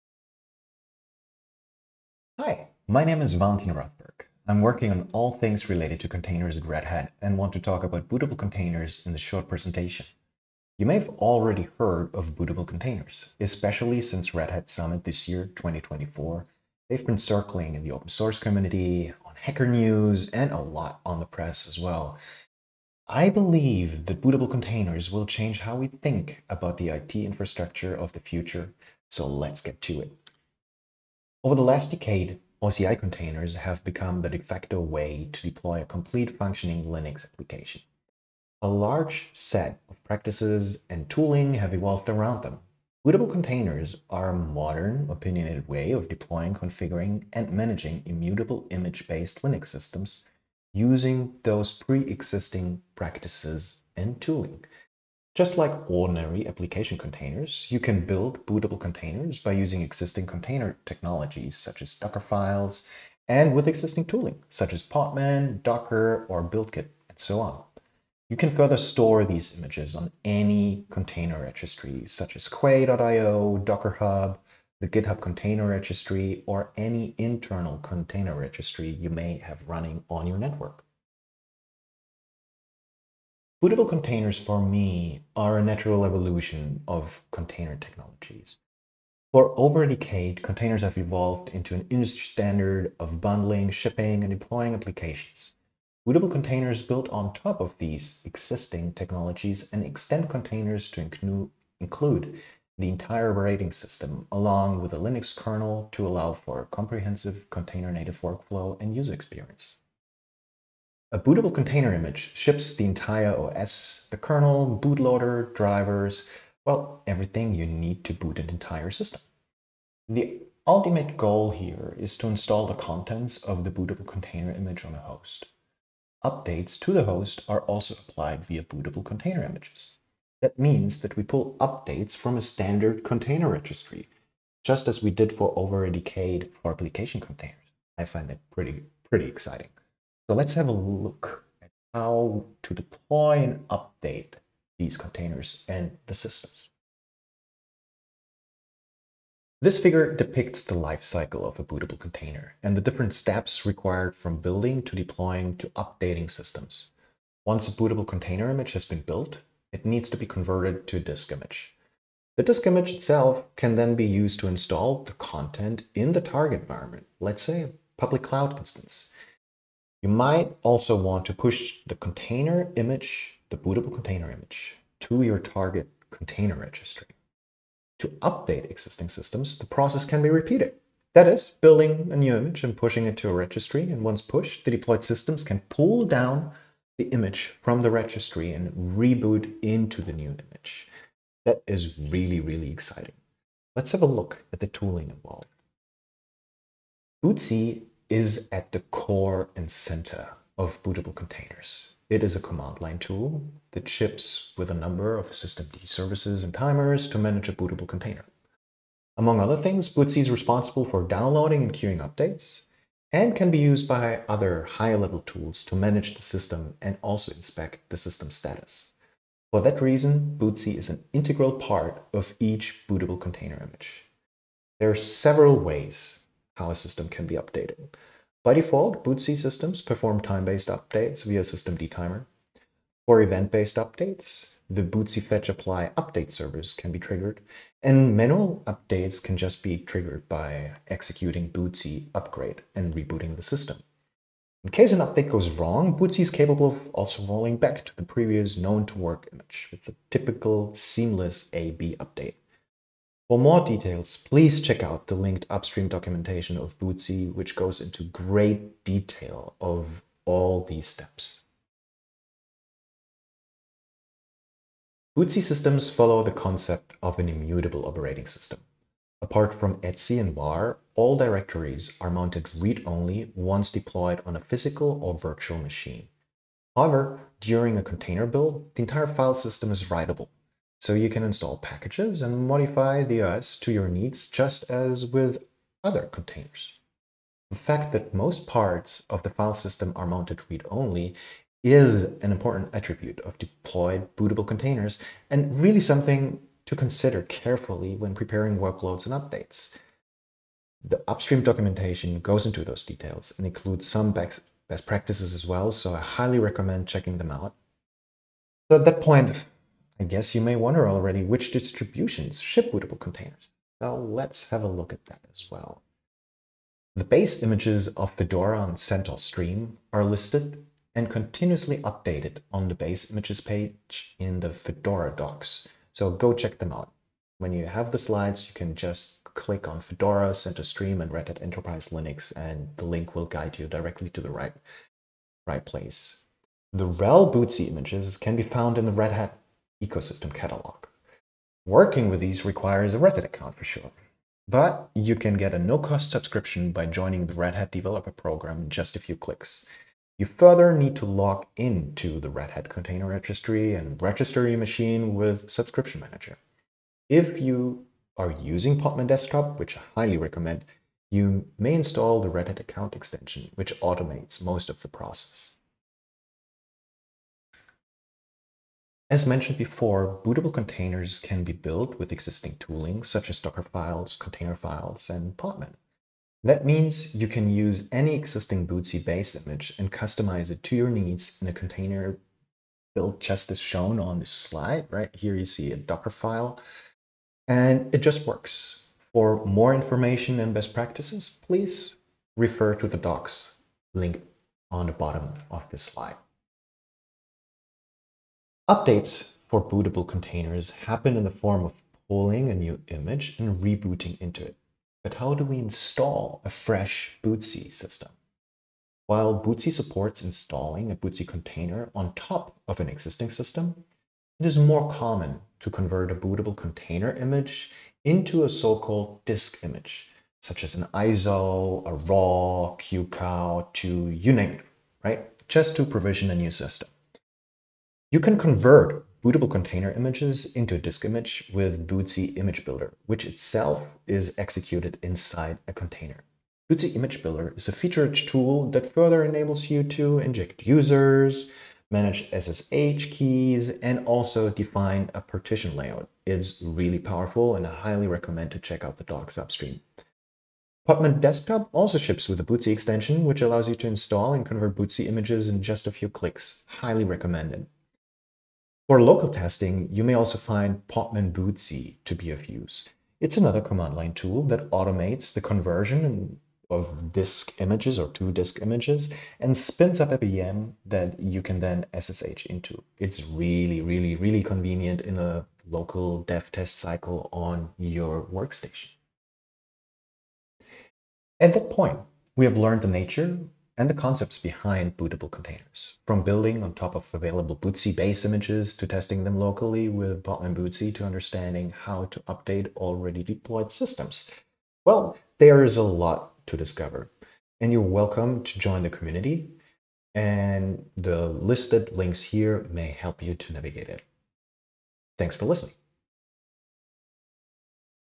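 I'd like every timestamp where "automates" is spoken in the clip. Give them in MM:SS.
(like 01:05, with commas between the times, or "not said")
06:03, 07:44.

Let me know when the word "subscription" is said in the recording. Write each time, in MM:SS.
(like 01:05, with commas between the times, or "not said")
05:46, 05:55.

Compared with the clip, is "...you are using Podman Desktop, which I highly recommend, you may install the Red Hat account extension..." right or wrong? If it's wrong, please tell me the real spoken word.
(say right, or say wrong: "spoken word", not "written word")
right.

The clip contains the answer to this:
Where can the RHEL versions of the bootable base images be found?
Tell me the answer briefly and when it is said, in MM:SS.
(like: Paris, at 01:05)
Red Hat ecosystem catalog, at 05:38.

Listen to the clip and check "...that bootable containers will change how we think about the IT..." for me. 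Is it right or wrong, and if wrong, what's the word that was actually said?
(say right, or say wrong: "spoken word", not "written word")
right.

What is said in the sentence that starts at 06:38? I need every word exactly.
Updates for bootable containers happen in the form of pulling a new image and rebooting into it.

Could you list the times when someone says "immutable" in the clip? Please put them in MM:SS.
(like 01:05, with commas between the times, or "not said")
00:48, 04:27.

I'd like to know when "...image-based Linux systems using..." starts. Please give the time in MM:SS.
00:48.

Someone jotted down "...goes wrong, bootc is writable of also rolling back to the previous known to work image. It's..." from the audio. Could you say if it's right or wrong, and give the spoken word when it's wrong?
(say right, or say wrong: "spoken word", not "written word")
wrong: "capable", not "writable".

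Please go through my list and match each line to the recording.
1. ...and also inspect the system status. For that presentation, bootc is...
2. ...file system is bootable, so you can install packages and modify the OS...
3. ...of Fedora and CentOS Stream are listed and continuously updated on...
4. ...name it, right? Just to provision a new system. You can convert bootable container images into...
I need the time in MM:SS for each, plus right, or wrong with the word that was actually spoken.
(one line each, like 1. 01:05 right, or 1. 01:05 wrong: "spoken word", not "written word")
1. 03:36 wrong: "reason", not "presentation"
2. 04:39 wrong: "writable", not "bootable"
3. 05:17 right
4. 07:04 right.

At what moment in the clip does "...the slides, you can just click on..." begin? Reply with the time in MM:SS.
05:27.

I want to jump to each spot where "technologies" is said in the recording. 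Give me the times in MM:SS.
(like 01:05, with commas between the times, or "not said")
01:00, 01:27, 01:38.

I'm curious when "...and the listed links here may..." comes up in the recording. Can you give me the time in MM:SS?
08:20.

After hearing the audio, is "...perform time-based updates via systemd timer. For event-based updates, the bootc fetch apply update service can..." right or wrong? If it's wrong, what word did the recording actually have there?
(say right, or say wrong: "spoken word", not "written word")
right.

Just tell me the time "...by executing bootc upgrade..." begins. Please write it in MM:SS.
04:00.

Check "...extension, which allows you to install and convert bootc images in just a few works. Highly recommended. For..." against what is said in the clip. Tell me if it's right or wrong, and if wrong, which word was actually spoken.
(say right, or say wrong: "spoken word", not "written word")
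wrong: "clicks", not "works".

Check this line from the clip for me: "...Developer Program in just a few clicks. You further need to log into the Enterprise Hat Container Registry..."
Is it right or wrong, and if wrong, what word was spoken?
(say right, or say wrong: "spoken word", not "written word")
wrong: "Red", not "Enterprise".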